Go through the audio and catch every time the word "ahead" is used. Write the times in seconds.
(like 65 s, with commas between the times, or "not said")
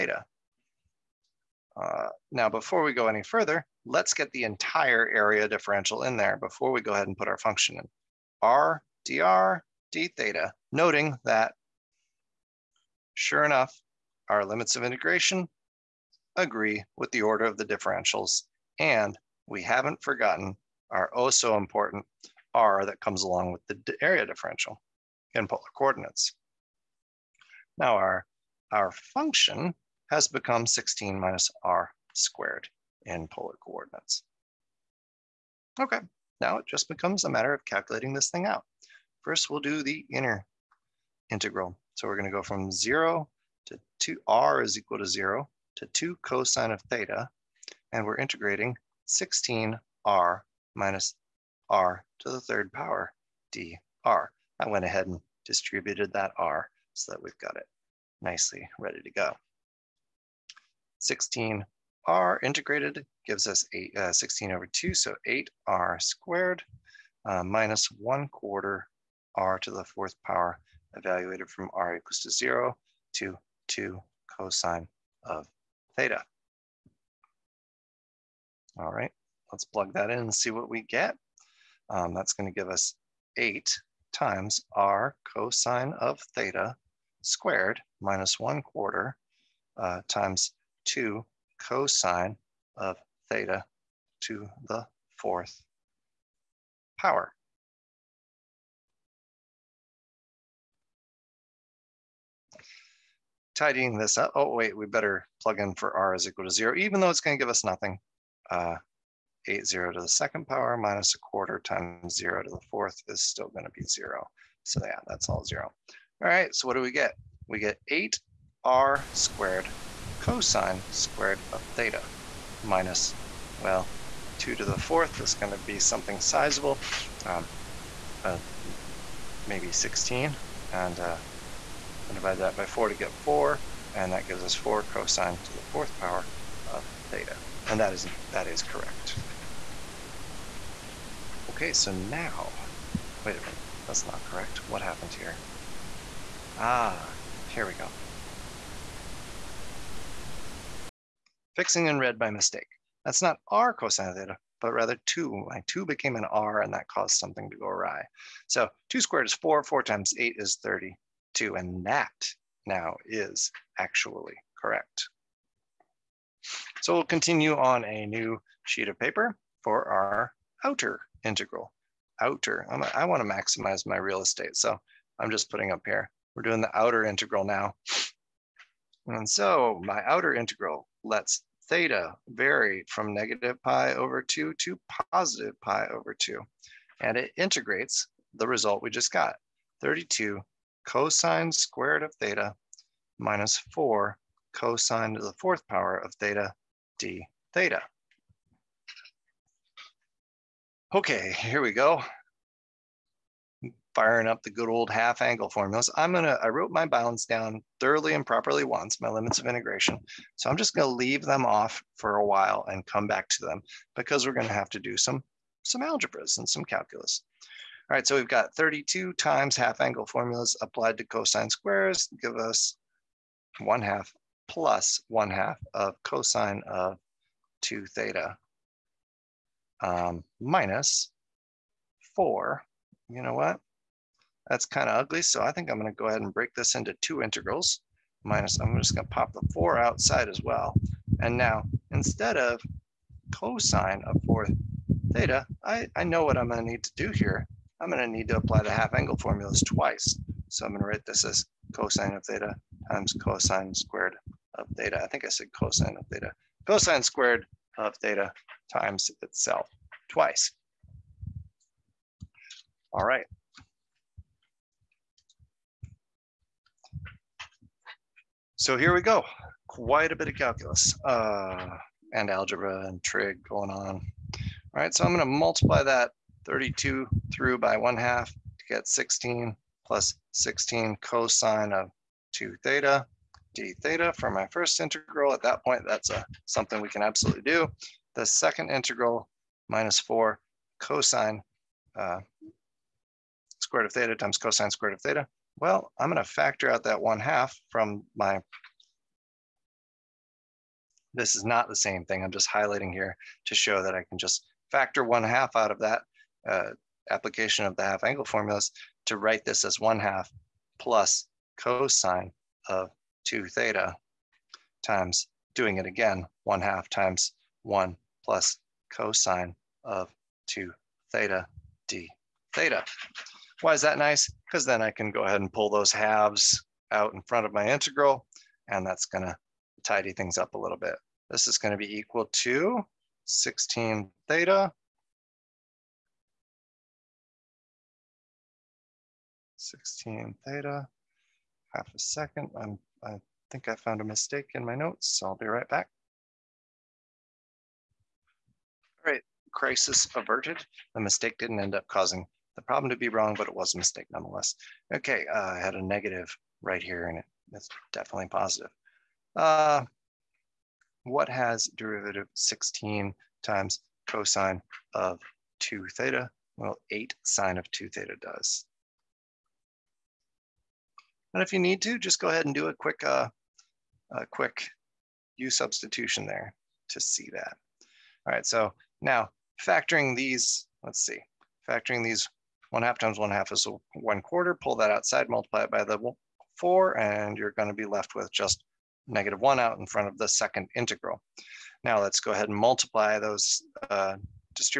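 6 s, 54 s, 236 s, 325 s, 372 s, 392 s.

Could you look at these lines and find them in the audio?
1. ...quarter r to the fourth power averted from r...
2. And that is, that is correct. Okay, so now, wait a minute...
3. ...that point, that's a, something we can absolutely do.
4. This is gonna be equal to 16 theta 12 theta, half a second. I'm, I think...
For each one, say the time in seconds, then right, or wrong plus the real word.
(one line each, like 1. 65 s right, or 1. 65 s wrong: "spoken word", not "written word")
1. 68 s wrong: "evaluated", not "averted"
2. 137 s right
3. 285 s right
4. 331 s wrong: "16", not "12".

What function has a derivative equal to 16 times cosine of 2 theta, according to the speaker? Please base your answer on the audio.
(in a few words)
8 sine of 2 theta.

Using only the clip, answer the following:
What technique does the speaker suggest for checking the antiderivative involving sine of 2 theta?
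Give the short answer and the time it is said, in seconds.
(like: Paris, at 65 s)
u substitution, at 375 s.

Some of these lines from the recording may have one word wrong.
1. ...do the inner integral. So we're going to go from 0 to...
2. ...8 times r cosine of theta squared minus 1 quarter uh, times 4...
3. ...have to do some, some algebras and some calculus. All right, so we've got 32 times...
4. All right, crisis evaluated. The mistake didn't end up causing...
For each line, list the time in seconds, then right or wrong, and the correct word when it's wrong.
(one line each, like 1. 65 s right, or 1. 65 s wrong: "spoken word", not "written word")
1. 39 s right
2. 83 s wrong: "2", not "4"
3. 214 s right
4. 349 s wrong: "averted", not "evaluated".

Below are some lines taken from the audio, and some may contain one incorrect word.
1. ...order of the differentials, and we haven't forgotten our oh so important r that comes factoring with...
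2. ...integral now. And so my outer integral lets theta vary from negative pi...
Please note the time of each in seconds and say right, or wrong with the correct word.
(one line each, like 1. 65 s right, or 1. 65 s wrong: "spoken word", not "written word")
1. 17 s wrong: "along", not "factoring"
2. 177 s right.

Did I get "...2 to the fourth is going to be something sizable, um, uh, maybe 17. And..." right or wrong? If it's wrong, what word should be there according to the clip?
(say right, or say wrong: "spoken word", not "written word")
wrong: "16", not "17".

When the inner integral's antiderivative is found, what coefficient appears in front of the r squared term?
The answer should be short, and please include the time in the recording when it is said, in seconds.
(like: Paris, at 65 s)
8, at 64 s.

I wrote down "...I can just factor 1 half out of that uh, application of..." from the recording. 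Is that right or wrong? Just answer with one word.
right.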